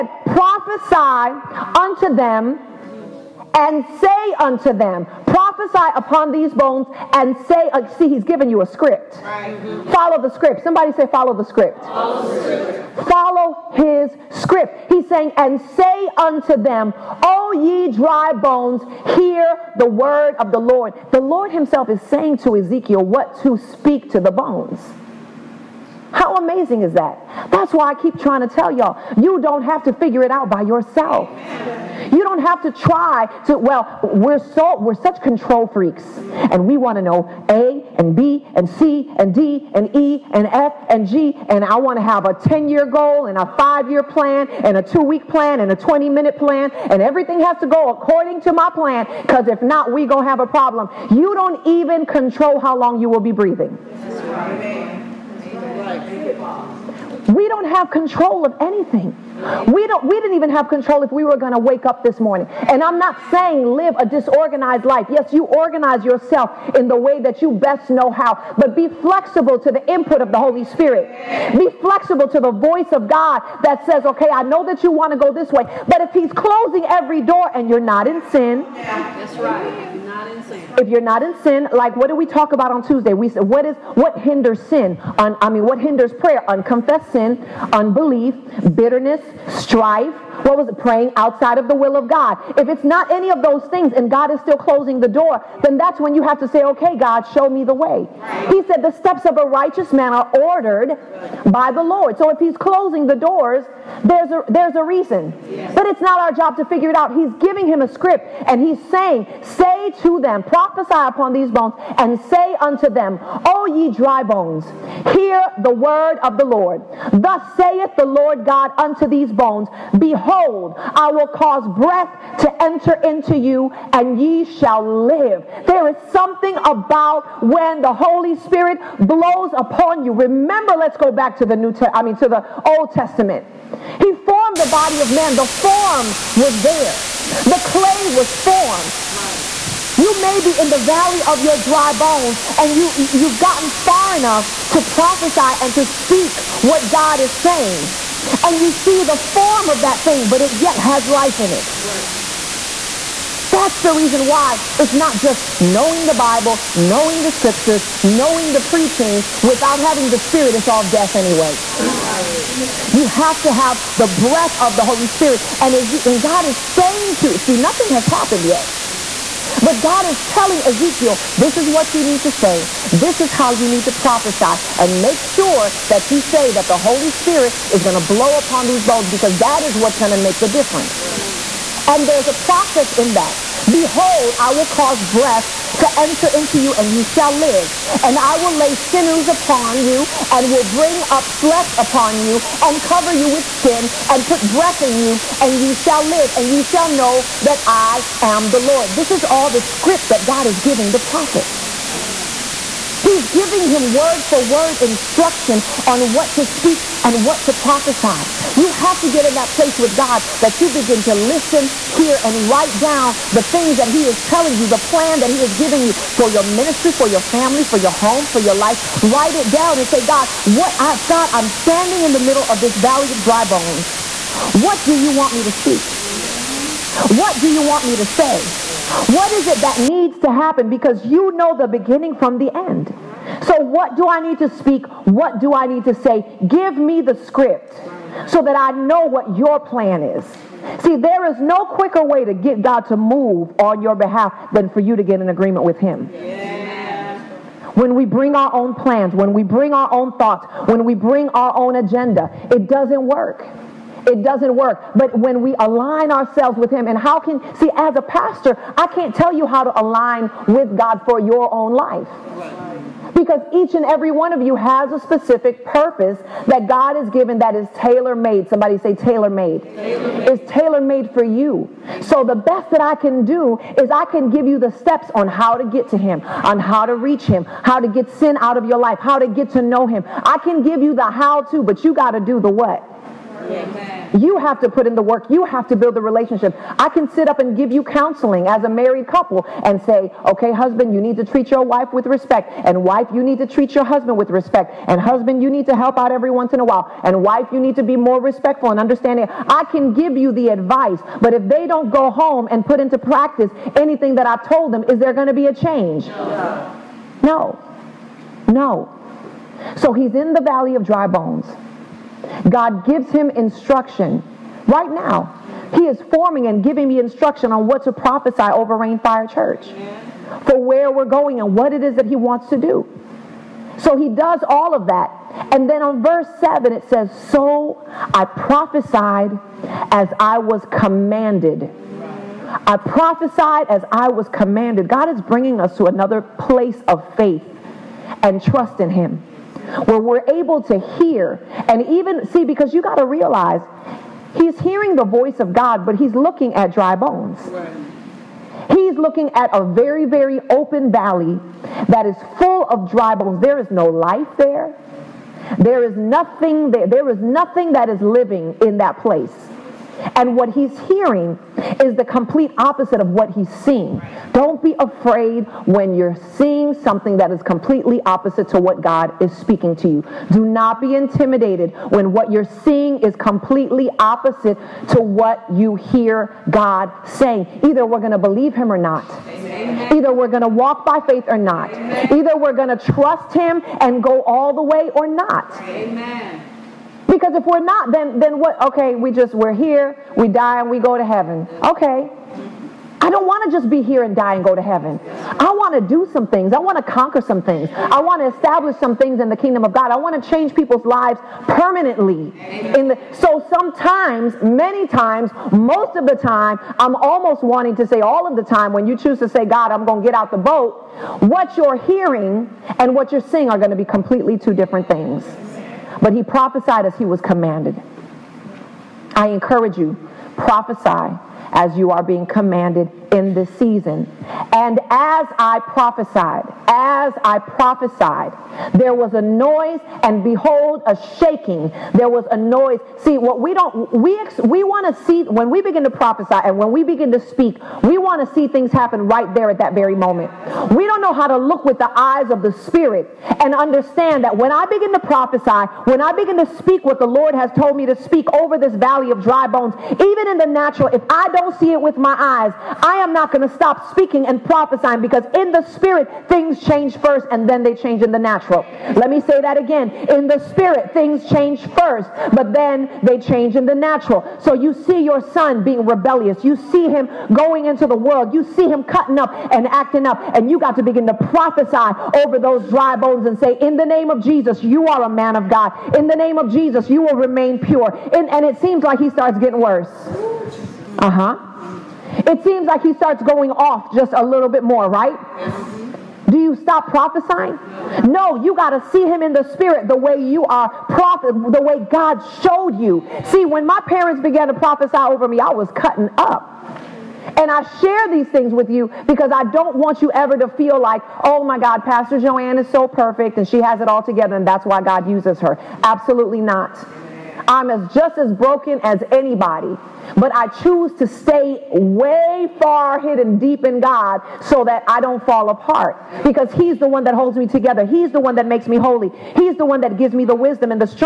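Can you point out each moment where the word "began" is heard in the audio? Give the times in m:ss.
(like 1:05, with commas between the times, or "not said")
8:14.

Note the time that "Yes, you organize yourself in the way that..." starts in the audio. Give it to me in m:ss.
1:05.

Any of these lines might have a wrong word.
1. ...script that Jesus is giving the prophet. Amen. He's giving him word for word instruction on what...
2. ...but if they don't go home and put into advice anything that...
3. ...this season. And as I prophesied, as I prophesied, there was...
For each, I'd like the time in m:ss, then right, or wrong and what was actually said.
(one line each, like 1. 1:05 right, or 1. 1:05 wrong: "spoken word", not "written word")
1. 3:19 wrong: "God", not "Jesus"
2. 5:01 wrong: "practice", not "advice"
3. 7:03 right.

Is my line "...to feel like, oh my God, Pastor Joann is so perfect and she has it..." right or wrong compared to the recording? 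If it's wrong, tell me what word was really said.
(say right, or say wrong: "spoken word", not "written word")
right.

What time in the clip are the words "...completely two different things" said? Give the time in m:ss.
6:53.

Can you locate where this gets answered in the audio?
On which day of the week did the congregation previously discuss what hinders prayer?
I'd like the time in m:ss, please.
1:22.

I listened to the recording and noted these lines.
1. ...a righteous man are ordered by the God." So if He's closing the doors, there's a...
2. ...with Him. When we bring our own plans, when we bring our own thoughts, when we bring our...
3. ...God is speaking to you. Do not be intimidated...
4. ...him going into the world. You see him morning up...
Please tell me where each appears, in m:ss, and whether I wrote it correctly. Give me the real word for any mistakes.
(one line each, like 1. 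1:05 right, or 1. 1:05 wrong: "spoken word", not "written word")
1. 1:39 wrong: "Lord", not "God"
2. 4:05 right
3. 6:08 right
4. 7:46 wrong: "cutting", not "morning".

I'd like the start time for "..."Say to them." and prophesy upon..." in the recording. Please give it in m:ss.
1:49.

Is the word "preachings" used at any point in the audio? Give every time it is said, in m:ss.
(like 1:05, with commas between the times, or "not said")
2:38.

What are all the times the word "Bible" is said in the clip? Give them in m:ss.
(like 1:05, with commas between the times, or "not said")
2:36.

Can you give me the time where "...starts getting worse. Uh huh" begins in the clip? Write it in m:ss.
7:59.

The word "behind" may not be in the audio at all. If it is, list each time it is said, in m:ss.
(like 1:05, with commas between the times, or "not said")
not said.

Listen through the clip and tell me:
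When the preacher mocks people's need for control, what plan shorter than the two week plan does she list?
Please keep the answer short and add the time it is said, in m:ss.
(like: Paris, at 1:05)
20 minute plan, at 0:45.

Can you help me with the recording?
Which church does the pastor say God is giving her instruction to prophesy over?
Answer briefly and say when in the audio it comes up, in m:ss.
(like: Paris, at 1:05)
Rainfire Church, at 5:18.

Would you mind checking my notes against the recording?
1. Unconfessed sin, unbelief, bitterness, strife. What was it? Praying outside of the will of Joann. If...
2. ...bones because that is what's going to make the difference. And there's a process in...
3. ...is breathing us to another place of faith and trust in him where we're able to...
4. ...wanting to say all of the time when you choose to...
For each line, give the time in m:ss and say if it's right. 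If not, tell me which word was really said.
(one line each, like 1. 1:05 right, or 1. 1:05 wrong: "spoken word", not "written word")
1. 1:26 wrong: "God", not "Joann"
2. 2:58 right
3. 5:35 wrong: "bringing", not "breathing"
4. 6:47 right.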